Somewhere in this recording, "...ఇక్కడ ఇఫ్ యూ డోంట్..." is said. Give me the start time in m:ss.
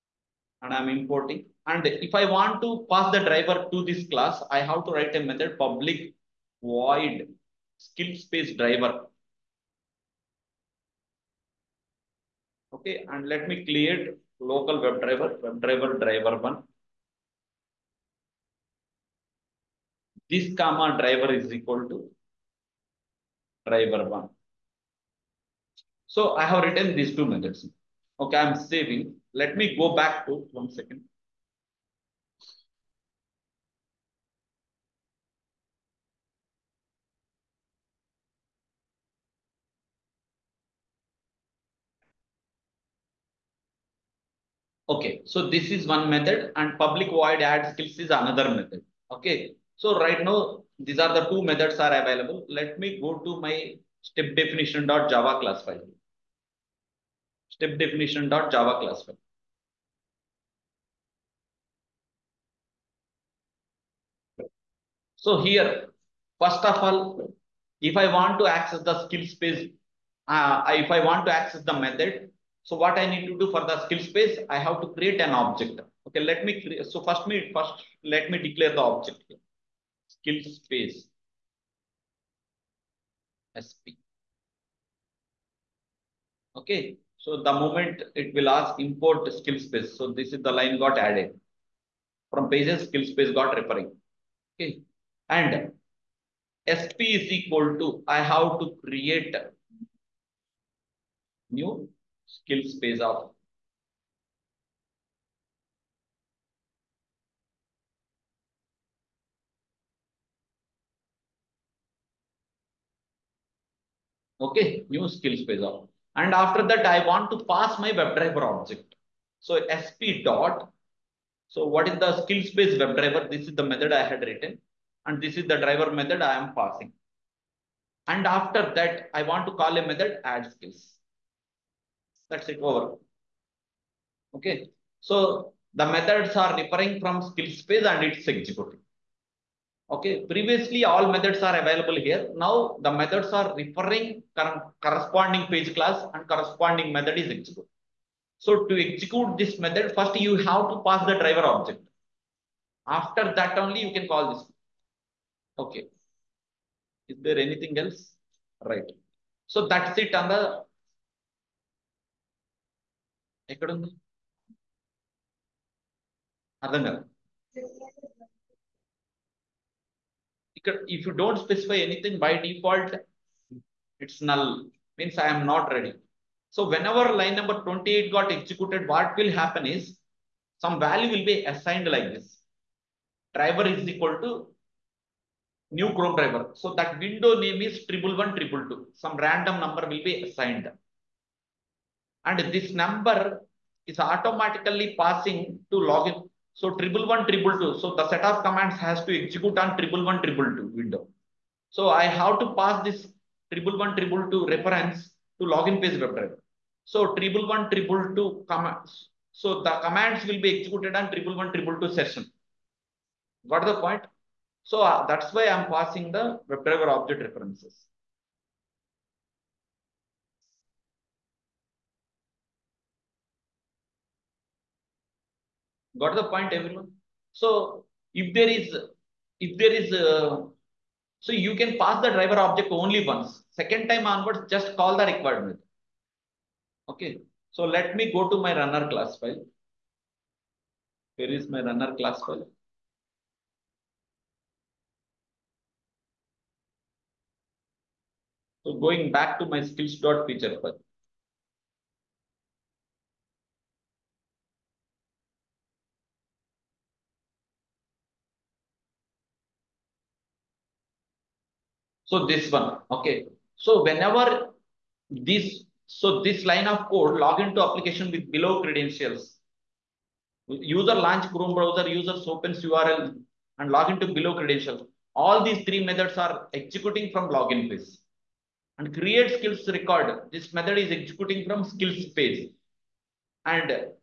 2:50.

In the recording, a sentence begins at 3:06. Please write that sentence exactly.
So that window name is triple one triple two.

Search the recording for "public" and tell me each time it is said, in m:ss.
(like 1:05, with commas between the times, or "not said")
0:05, 0:46.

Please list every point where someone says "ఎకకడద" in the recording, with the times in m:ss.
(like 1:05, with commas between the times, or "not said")
2:43.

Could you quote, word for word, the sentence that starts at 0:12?
Okay, and let me clear local WebDriver, WebDriver driver 1.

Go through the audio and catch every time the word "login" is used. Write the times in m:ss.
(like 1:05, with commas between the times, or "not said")
3:15, 3:25, 4:37.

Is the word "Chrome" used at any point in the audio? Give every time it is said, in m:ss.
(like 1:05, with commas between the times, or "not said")
3:05, 4:31.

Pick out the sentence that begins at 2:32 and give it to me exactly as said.
After that only you can call this.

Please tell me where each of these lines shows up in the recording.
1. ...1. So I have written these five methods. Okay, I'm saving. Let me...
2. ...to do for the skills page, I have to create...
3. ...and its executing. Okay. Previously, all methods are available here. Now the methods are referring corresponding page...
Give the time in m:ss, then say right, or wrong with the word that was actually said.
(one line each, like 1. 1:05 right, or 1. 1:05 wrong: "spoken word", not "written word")
1. 0:24 wrong: "two", not "five"
2. 1:13 right
3. 2:17 right.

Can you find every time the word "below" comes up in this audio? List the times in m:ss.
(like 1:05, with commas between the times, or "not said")
4:28, 4:34.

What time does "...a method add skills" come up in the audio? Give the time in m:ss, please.
2:09.